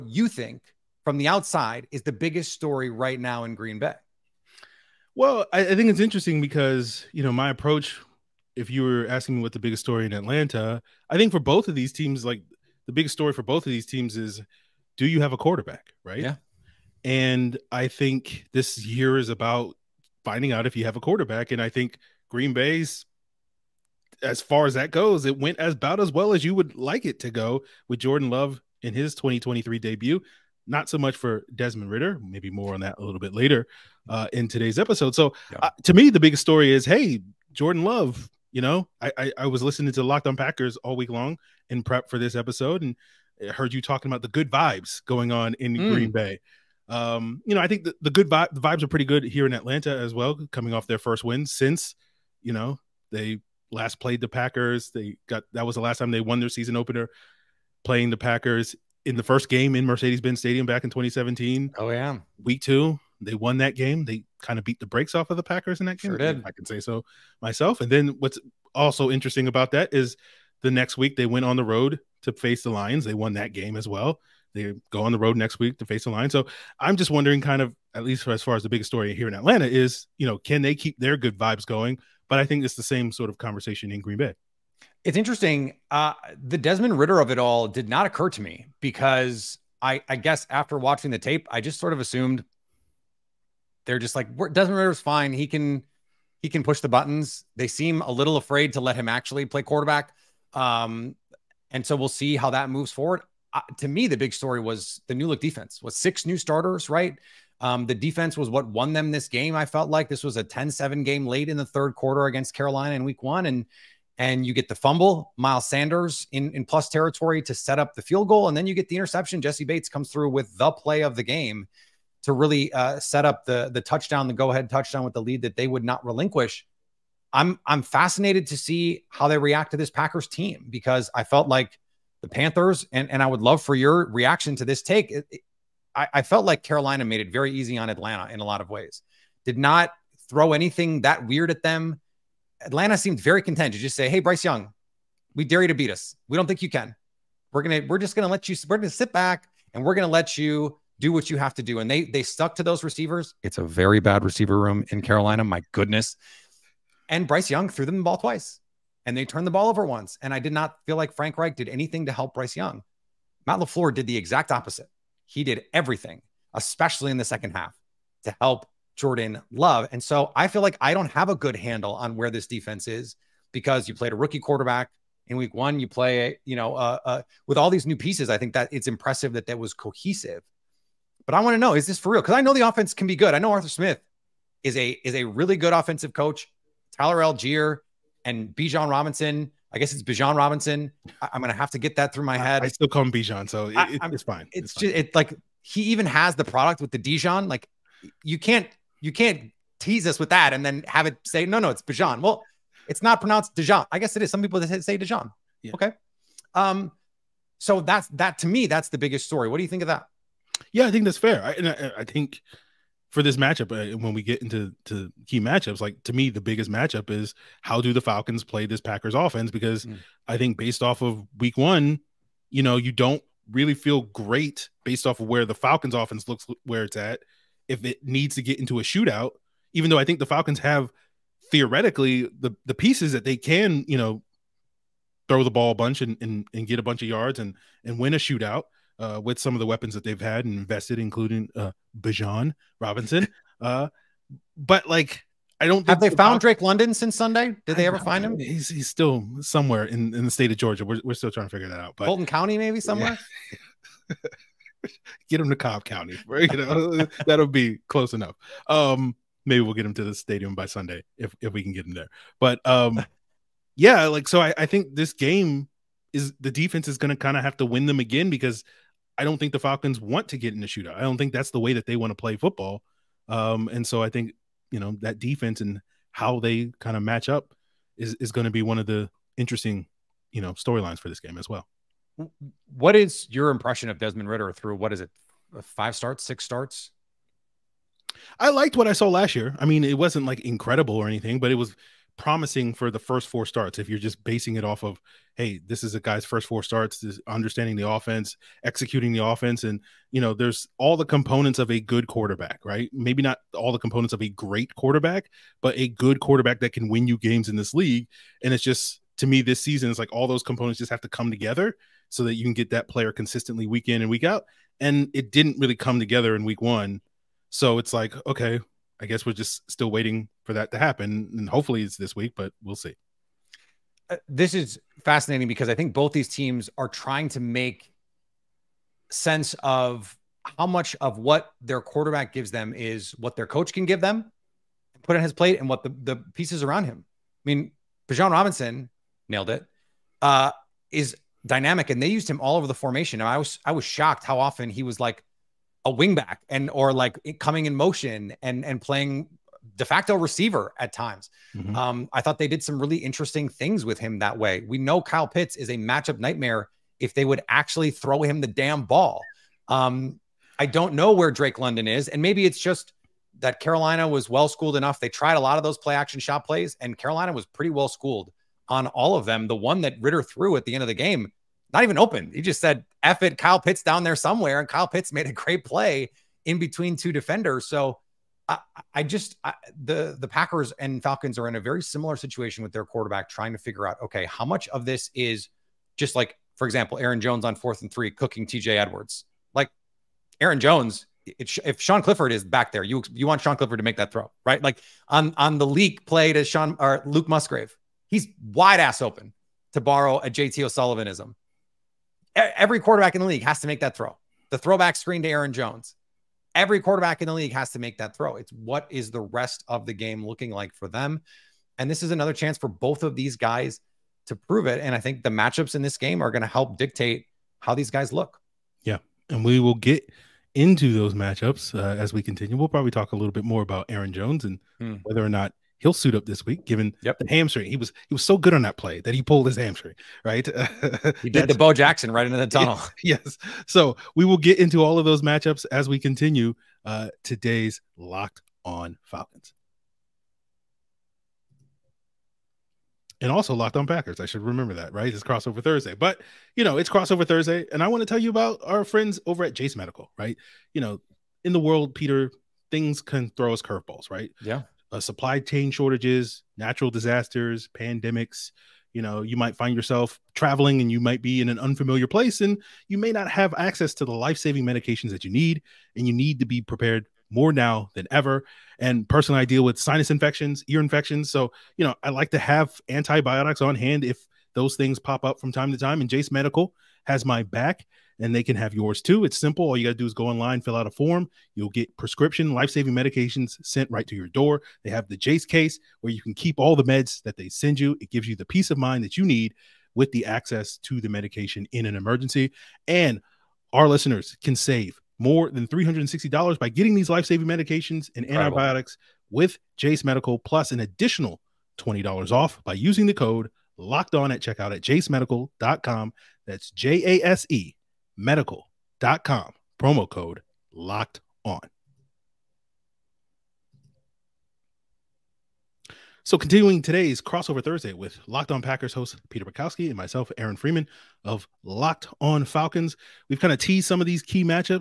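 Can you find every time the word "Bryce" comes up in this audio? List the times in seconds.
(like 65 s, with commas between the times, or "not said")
144 s, 157 s, 162 s.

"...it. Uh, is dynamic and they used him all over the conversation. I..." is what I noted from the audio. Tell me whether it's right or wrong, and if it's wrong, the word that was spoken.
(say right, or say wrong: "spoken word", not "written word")
wrong: "formation", not "conversation".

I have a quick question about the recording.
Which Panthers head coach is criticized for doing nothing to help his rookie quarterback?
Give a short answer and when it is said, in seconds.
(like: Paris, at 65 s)
Frank Reich, at 161 s.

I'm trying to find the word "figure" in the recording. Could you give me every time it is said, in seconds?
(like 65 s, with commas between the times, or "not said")
251 s, 383 s.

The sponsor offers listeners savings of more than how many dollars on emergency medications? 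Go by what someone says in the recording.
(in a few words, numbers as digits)
$360.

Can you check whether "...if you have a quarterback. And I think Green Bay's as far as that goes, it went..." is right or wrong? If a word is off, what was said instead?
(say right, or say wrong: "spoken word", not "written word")
right.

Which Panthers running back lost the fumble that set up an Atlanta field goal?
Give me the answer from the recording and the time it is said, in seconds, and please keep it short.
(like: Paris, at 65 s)
Miles Sanders, at 115 s.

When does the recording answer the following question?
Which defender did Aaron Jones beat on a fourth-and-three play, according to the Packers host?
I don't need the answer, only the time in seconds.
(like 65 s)
388 s.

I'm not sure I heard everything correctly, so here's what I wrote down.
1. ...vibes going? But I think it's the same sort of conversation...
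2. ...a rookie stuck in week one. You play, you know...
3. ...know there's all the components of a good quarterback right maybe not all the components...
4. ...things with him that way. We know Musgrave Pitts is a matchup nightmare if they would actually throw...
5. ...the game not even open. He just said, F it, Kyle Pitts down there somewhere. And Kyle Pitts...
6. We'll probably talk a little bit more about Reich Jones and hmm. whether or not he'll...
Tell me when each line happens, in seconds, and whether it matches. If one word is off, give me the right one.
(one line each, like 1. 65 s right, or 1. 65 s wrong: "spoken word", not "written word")
1. 81 s right
2. 174 s wrong: "quarterback", not "stuck"
3. 300 s right
4. 353 s wrong: "Kyle", not "Musgrave"
5. 370 s right
6. 422 s wrong: "Aaron", not "Reich".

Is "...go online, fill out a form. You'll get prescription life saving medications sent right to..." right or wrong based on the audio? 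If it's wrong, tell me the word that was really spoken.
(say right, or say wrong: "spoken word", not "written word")
right.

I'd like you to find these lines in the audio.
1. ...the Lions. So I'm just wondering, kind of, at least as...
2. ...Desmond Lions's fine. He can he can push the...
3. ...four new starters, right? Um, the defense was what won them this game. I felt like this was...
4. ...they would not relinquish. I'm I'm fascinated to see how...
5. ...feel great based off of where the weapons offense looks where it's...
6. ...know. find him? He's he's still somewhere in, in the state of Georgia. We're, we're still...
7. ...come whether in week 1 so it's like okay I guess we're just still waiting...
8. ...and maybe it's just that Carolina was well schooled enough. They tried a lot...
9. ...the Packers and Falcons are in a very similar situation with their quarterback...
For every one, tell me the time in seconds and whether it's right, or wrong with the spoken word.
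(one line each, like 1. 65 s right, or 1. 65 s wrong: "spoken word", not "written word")
1. 76 s right
2. 94 s wrong: "Ridder", not "Lions"
3. 105 s wrong: "six", not "four"
4. 125 s right
5. 223 s wrong: "falcons", not "weapons"
6. 247 s right
7. 315 s wrong: "together", not "whether"
8. 362 s right
9. 380 s right.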